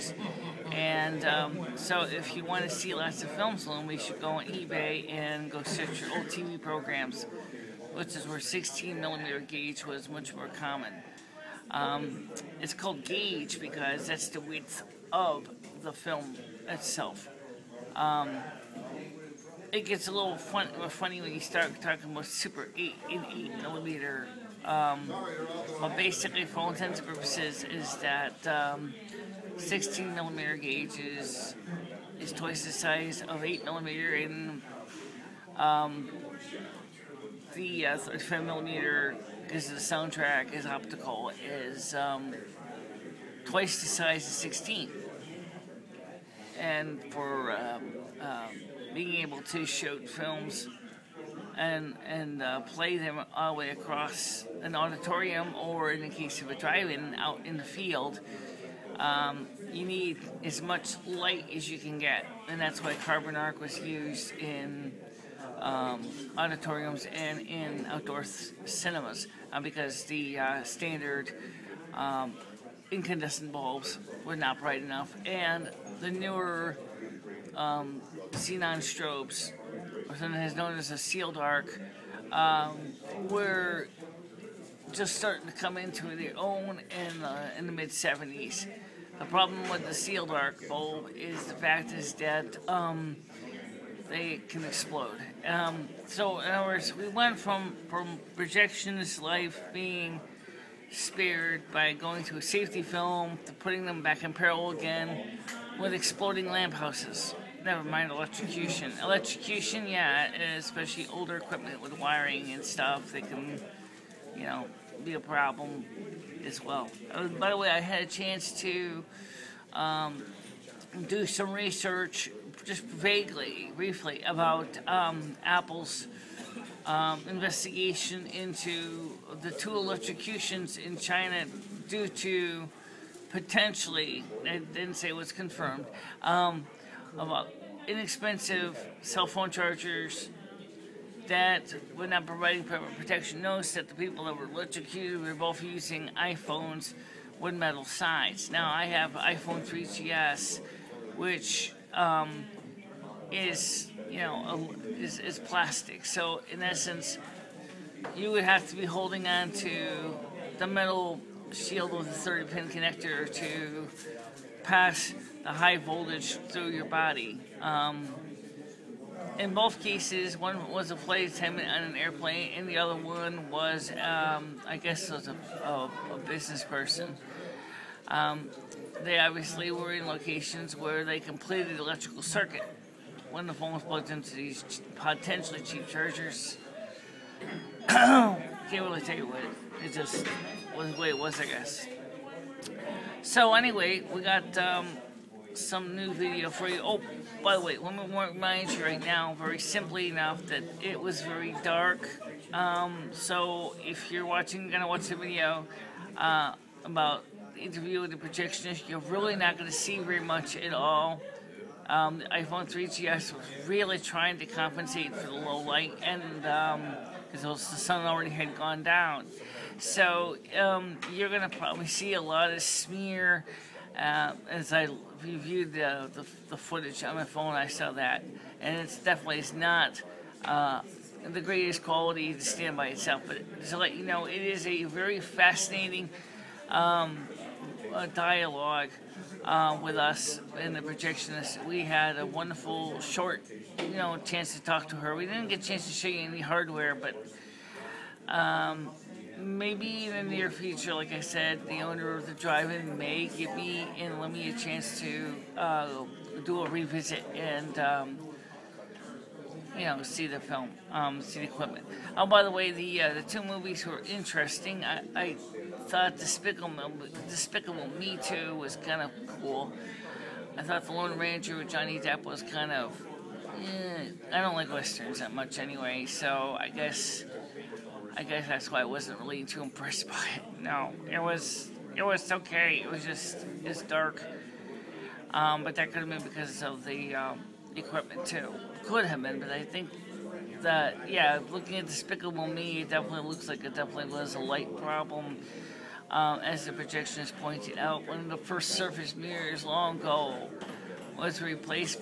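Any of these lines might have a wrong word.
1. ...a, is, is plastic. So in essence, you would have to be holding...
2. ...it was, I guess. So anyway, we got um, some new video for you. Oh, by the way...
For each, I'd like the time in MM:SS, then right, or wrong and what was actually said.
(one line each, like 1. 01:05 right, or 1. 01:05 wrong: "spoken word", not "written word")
1. 02:34 right
2. 03:11 right.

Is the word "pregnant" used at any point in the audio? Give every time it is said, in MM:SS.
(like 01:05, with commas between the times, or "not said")
not said.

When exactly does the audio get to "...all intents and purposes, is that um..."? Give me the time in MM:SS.
00:26.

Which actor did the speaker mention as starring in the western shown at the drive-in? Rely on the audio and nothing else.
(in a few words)
Johnny Depp.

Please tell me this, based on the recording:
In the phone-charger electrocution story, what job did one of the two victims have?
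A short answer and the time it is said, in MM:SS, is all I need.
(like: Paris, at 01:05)
Flight attendant, at 02:50.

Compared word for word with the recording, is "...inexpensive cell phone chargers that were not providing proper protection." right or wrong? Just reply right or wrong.
right.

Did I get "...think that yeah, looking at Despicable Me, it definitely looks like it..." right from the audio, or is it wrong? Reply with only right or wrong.
right.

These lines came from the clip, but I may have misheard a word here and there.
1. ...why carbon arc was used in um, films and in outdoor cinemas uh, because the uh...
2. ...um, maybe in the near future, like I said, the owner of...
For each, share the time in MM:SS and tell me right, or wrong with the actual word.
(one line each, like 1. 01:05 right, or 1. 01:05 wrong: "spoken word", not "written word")
1. 01:02 wrong: "auditoriums", not "films"
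2. 04:08 right.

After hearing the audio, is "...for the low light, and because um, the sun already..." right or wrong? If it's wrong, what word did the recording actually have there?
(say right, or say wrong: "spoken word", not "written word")
right.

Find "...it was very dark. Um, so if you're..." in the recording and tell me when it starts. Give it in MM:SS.
03:20.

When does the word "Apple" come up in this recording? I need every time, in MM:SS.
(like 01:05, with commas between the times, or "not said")
02:05.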